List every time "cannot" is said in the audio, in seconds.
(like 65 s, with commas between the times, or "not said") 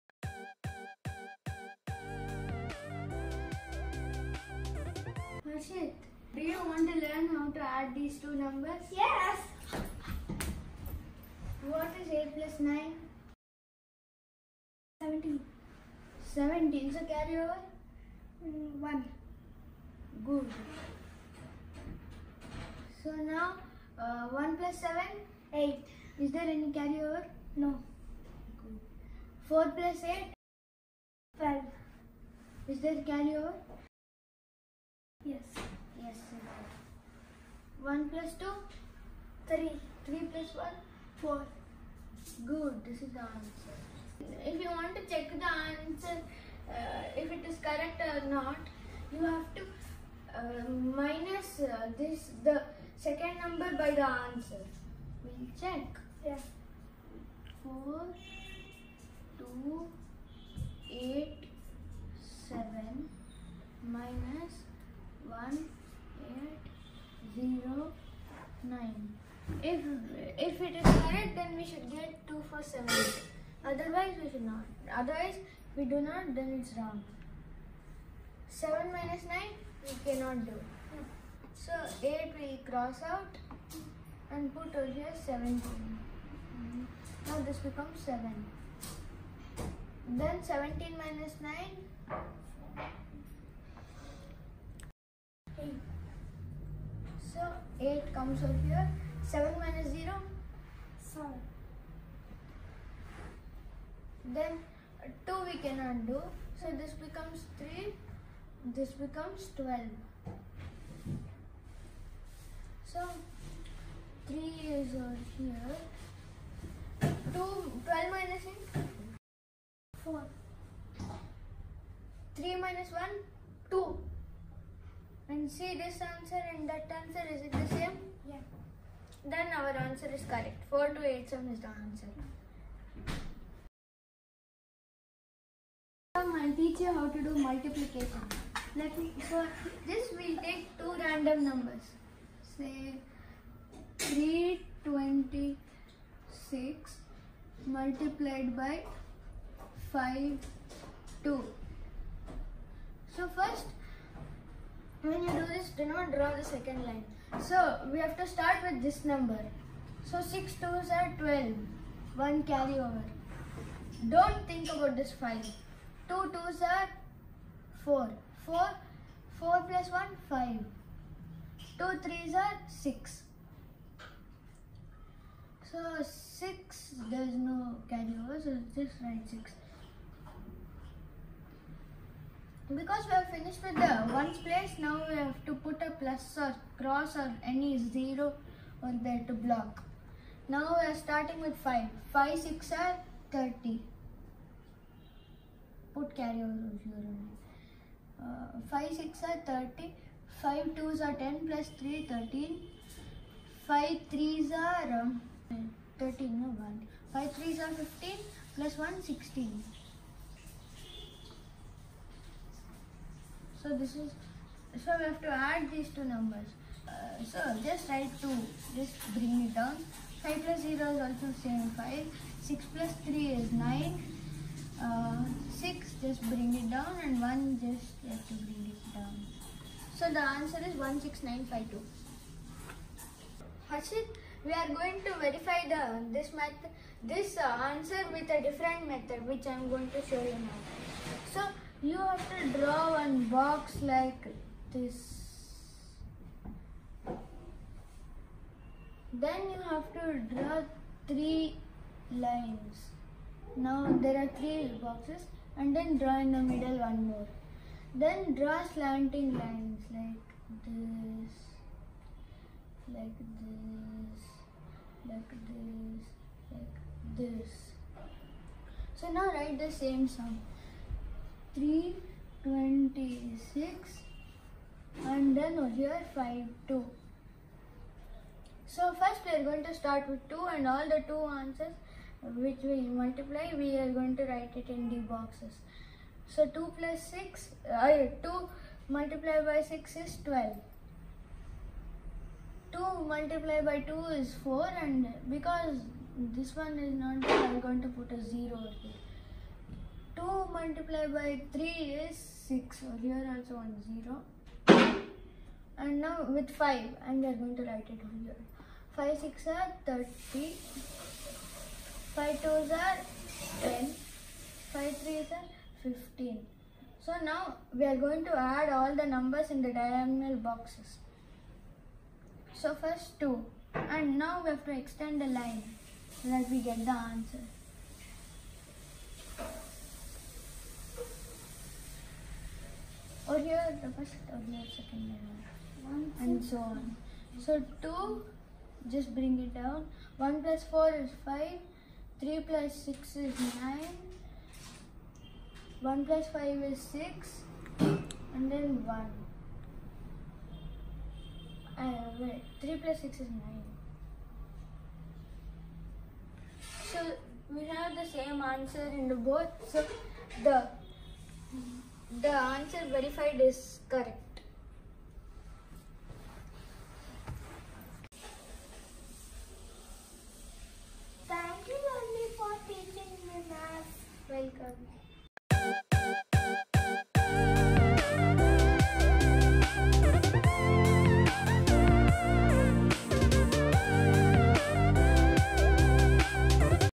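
80 s, 105 s.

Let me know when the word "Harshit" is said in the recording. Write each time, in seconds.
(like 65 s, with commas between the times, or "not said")
5 s, 233 s.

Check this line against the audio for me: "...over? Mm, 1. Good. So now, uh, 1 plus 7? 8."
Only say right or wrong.
right.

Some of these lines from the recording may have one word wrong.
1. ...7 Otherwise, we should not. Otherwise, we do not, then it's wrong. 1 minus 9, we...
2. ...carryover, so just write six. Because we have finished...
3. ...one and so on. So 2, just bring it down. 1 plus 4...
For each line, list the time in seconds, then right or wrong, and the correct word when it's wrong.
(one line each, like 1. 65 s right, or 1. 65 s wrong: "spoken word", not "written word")
1. 72 s wrong: "7", not "1"
2. 177 s right
3. 335 s right.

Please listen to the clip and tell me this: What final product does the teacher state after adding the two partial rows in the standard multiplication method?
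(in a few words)
16952.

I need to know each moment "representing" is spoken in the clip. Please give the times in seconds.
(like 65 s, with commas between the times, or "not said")
not said.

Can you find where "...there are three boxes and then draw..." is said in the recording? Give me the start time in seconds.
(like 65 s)
254 s.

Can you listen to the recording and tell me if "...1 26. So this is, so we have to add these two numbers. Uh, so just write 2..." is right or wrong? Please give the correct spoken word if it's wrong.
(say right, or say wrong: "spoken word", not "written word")
wrong: "16", not "26".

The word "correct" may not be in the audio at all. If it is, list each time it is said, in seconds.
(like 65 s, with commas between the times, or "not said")
47 s, 130 s, 363 s.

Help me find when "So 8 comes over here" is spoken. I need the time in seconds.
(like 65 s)
97 s.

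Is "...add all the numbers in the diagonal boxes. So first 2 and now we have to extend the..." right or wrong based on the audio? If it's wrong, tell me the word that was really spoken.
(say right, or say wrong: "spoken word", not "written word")
right.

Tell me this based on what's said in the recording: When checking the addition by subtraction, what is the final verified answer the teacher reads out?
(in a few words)
487.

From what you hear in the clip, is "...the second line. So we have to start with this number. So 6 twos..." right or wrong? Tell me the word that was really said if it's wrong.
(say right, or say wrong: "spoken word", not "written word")
right.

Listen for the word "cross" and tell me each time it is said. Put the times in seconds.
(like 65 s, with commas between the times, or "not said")
82 s, 186 s.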